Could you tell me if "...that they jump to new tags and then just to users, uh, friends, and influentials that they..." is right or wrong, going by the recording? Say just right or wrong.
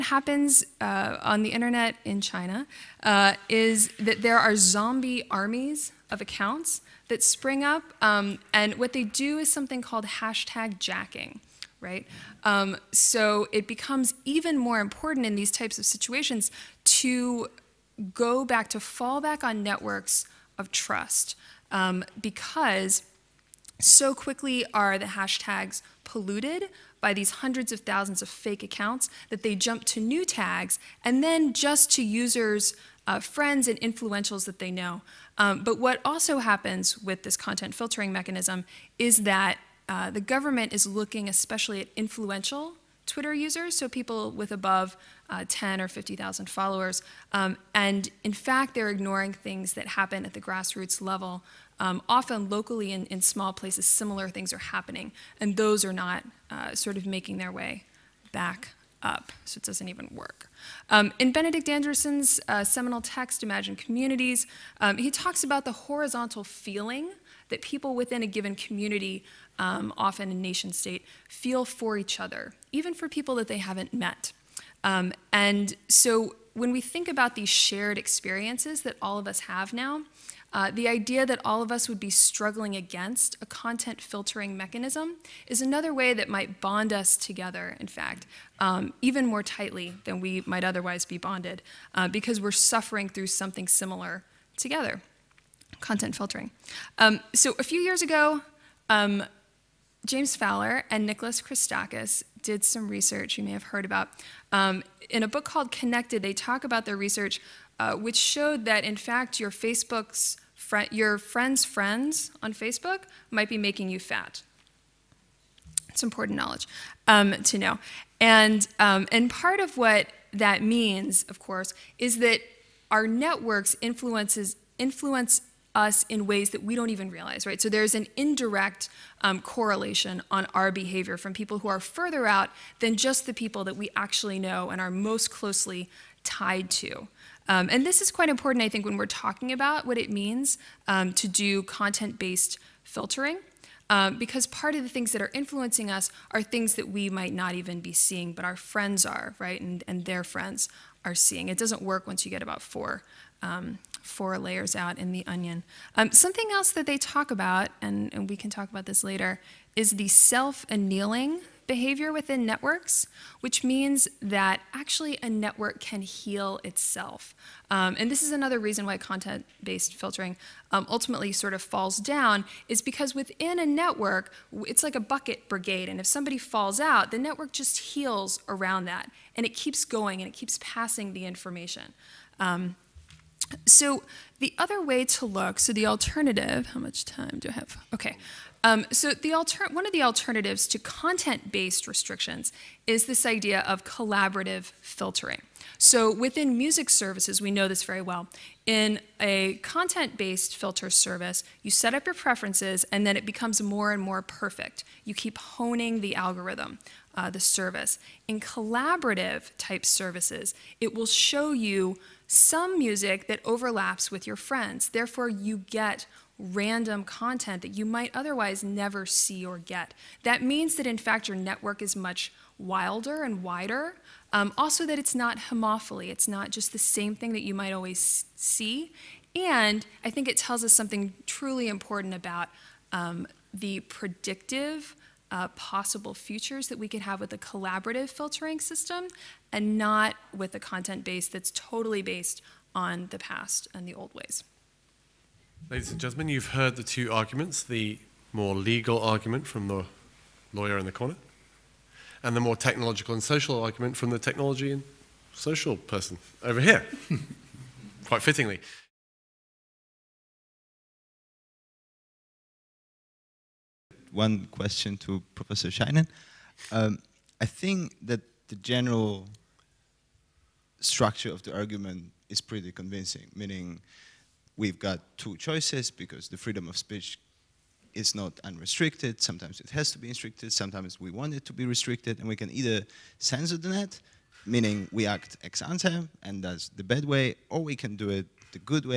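right.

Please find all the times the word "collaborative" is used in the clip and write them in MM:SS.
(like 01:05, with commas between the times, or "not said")
03:13, 03:28, 03:57.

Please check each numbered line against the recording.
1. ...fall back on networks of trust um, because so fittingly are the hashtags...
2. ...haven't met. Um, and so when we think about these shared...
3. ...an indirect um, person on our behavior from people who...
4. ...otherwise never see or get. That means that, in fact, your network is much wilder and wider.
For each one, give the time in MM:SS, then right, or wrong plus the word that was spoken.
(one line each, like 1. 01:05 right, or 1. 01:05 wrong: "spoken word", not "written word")
1. 00:18 wrong: "quickly", not "fittingly"
2. 01:13 right
3. 02:07 wrong: "correlation", not "person"
4. 03:38 right.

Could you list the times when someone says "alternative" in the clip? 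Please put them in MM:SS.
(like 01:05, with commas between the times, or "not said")
03:05, 03:10.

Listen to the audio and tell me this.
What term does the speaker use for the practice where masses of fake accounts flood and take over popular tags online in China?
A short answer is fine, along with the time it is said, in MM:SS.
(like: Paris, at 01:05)
hashtag jacking, at 00:10.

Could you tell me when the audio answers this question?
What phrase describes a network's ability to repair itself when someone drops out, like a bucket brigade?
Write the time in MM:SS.
02:40.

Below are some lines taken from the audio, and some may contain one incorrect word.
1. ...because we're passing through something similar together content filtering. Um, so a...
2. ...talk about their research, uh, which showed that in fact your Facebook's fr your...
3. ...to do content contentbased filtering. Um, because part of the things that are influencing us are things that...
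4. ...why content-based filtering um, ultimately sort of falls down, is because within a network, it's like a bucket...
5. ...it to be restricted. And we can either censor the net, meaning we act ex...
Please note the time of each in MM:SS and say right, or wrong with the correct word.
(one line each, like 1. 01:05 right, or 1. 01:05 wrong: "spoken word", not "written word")
1. 01:32 wrong: "suffering", not "passing"
2. 01:46 right
3. 02:21 wrong: "based", not "contentbased"
4. 02:48 right
5. 04:41 right.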